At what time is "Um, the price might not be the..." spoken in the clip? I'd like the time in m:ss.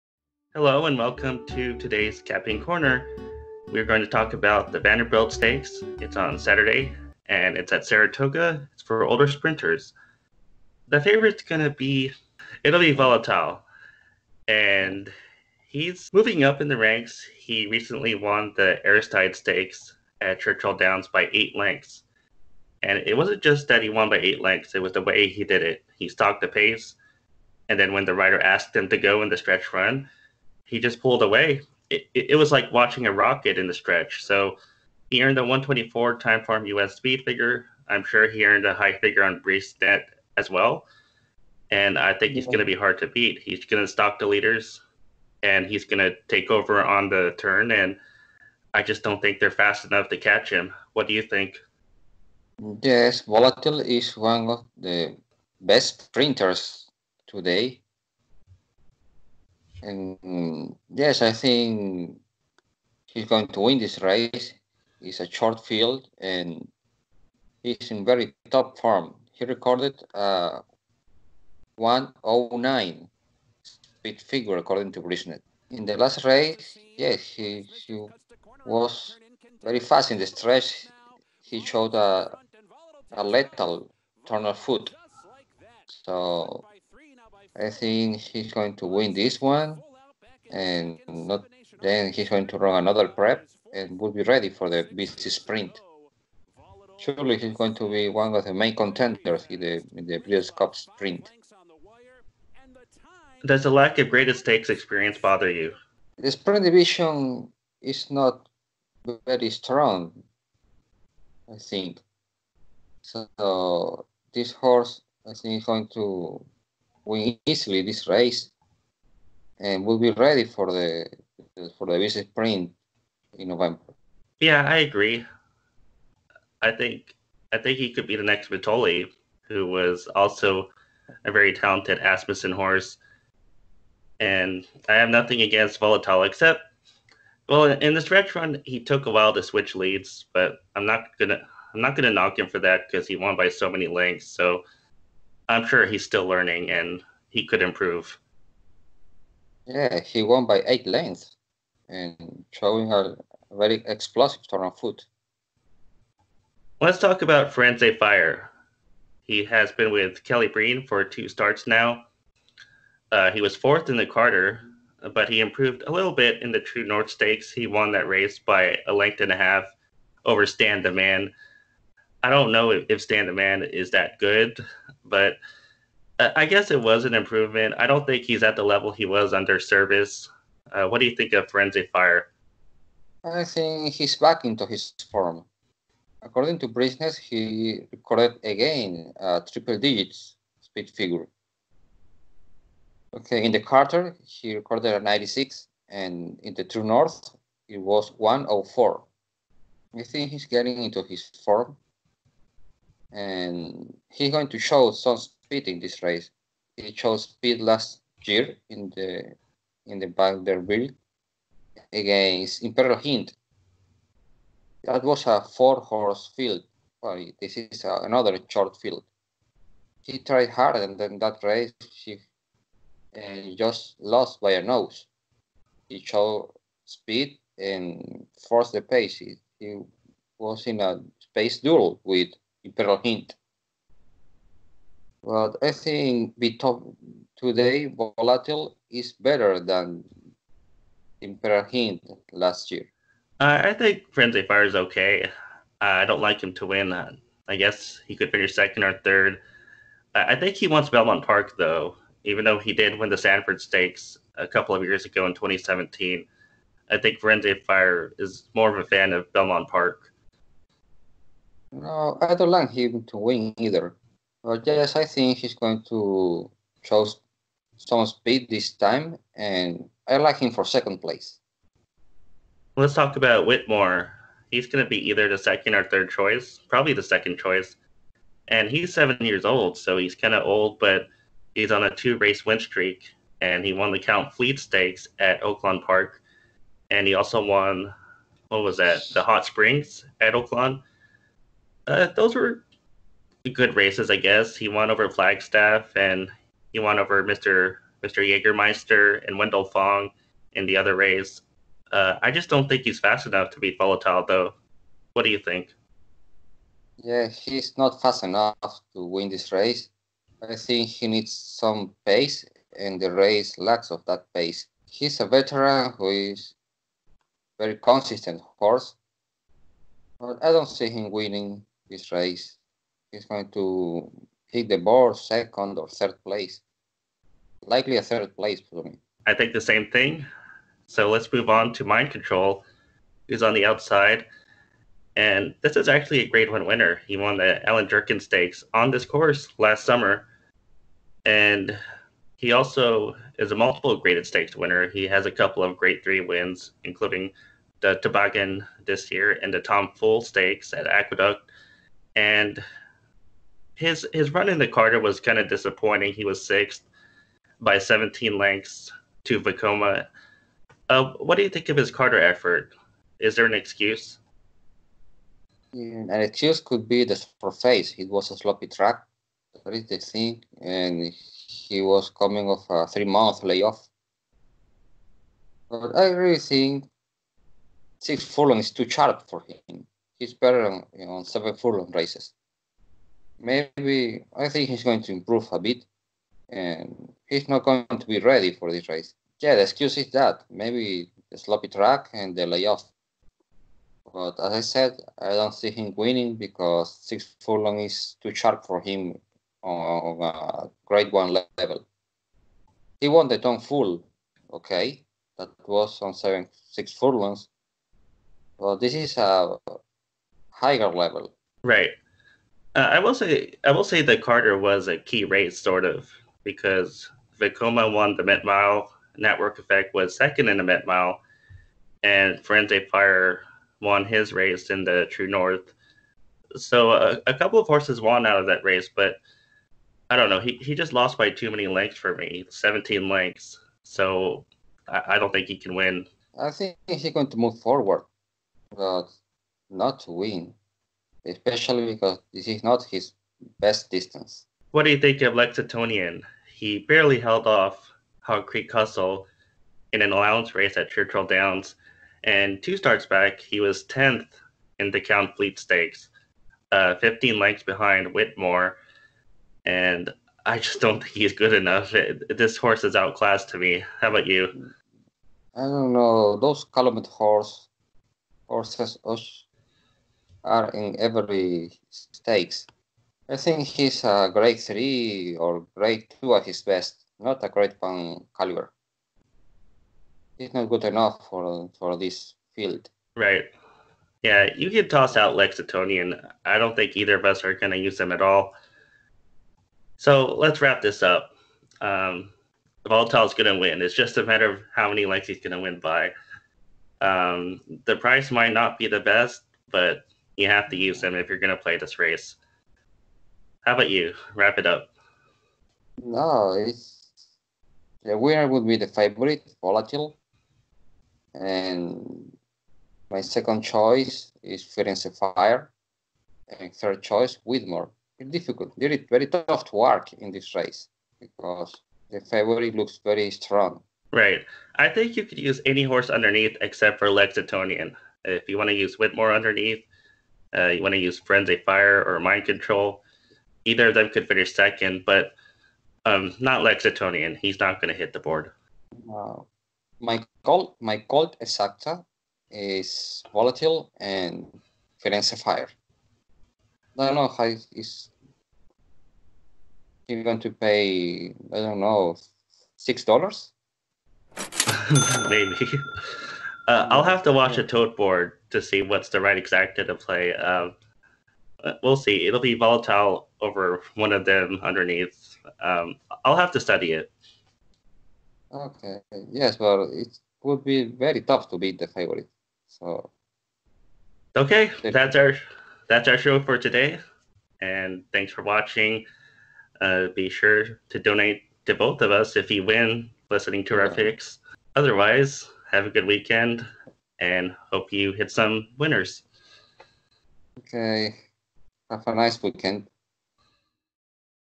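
8:17.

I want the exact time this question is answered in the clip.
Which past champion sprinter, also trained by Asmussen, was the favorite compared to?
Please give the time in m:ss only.
2:08.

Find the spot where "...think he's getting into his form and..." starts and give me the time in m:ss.
3:20.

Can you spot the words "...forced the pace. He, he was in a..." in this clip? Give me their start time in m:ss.
3:48.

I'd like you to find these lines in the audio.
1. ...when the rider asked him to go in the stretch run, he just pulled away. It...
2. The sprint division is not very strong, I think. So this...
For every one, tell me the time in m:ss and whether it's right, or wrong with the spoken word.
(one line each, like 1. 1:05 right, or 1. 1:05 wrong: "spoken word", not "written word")
1. 0:27 right
2. 1:46 right.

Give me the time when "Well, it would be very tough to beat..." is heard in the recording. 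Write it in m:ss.
9:29.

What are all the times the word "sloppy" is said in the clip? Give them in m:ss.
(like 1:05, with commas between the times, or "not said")
6:08, 6:31.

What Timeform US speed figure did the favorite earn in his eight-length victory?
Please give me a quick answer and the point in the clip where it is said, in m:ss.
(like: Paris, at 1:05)
124, at 0:35.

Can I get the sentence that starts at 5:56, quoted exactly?
He was sixth by 17 lengths to Vekoma.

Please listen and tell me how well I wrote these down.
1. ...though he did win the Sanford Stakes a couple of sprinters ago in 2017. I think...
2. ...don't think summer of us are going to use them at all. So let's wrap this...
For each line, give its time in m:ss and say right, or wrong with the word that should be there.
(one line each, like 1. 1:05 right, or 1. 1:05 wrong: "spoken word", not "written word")
1. 4:12 wrong: "years", not "sprinters"
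2. 8:06 wrong: "either", not "summer".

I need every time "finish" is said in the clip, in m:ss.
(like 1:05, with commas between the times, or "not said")
4:08, 8:54.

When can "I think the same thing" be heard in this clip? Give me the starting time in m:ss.
5:29.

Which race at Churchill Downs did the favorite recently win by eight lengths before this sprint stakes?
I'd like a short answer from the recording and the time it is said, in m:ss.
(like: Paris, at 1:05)
Aristides Stakes, at 0:18.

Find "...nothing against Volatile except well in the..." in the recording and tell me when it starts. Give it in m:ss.
2:15.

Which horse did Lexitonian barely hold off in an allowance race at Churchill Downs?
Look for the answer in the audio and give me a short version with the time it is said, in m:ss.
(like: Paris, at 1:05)
Hog Creek Hustle, at 7:28.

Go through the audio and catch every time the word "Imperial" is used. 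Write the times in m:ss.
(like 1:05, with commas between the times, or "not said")
3:32, 4:01.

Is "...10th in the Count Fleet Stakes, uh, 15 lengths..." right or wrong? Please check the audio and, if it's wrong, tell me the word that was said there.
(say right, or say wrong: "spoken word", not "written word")
right.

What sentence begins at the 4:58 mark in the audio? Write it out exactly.
Jägermeister and Wendell Fong in the other race.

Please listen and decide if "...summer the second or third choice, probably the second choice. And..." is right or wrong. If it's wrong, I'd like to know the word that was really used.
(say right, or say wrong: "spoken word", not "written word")
wrong: "either", not "summer".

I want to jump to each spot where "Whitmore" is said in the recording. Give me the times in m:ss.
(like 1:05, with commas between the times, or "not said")
4:33, 7:38, 8:37, 8:48.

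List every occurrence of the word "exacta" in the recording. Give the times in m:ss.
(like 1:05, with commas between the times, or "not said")
9:01, 9:19.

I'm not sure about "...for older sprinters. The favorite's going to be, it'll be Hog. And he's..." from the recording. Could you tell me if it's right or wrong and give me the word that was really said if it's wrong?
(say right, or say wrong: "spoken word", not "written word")
wrong: "Volatile", not "Hog".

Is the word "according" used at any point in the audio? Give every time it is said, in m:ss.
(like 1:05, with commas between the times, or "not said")
1:14, 3:06.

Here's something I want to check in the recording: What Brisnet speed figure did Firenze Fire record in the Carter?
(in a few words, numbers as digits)
96.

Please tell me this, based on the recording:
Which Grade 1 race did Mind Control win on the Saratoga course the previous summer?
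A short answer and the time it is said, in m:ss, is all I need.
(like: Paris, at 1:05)
Allen Jerkens Stakes, at 5:37.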